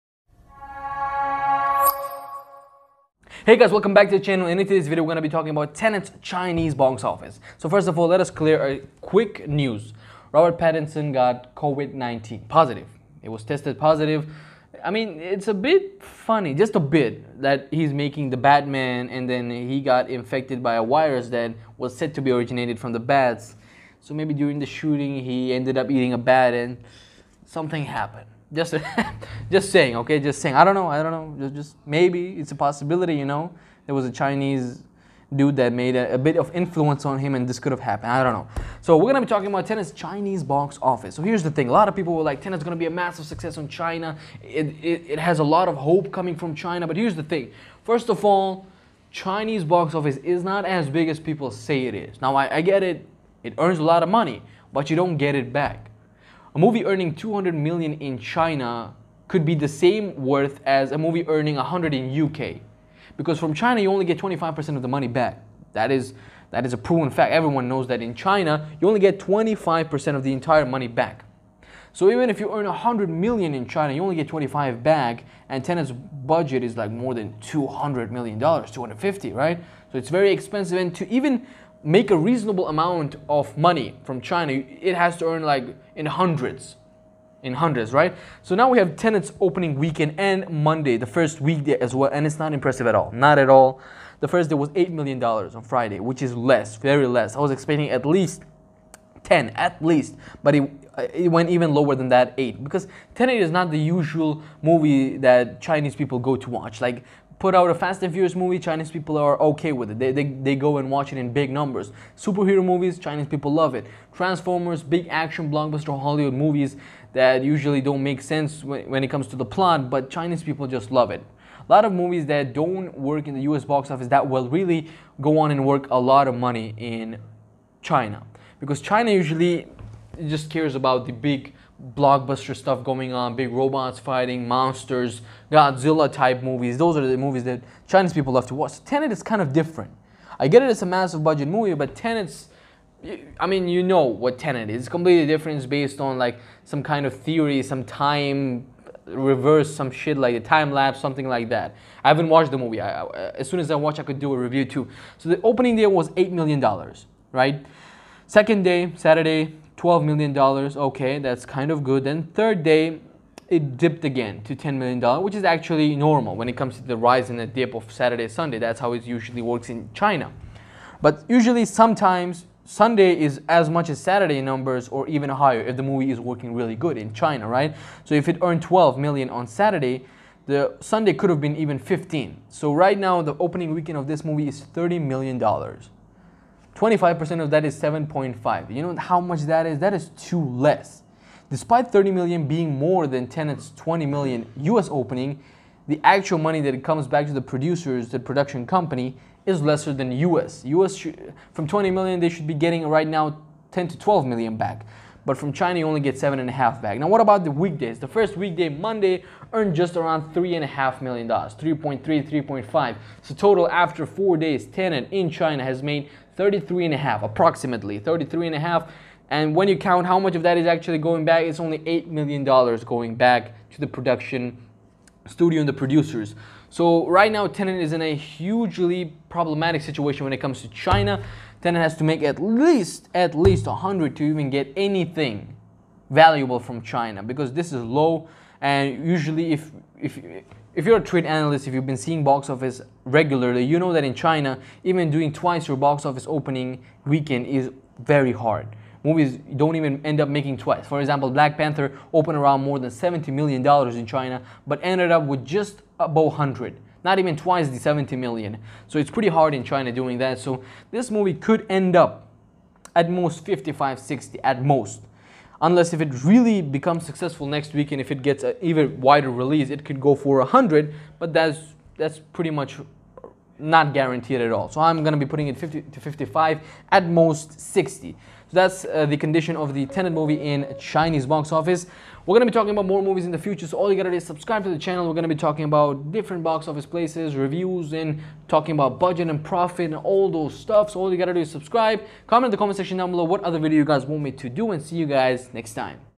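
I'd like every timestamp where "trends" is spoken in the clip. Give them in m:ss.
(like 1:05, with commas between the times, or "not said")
not said.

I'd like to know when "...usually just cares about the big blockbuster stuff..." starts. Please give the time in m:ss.
2:09.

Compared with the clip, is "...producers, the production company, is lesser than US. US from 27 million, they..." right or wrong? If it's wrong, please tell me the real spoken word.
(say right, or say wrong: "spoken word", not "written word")
wrong: "20", not "27".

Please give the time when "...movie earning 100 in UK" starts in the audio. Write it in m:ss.
1:00.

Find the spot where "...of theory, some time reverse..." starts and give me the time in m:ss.
2:27.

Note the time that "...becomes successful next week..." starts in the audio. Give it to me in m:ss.
4:26.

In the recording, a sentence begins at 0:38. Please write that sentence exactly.
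So we're gonna be talking about Tenet's Chinese box office.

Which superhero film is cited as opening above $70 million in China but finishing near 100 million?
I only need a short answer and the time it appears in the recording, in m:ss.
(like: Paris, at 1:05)
Black Panther, at 4:11.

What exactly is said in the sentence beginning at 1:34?
The first day was $8 million on Friday, which is less, very less.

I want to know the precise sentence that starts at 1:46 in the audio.
Like, put out a Fast and Furious movie, Chinese people are okay with it.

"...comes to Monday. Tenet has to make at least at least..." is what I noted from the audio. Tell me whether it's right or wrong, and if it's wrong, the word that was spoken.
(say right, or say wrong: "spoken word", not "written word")
wrong: "China", not "Monday".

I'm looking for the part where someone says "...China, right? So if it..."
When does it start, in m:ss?
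2:57.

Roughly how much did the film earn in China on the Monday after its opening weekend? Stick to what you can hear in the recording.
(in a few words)
3.5 million dollars.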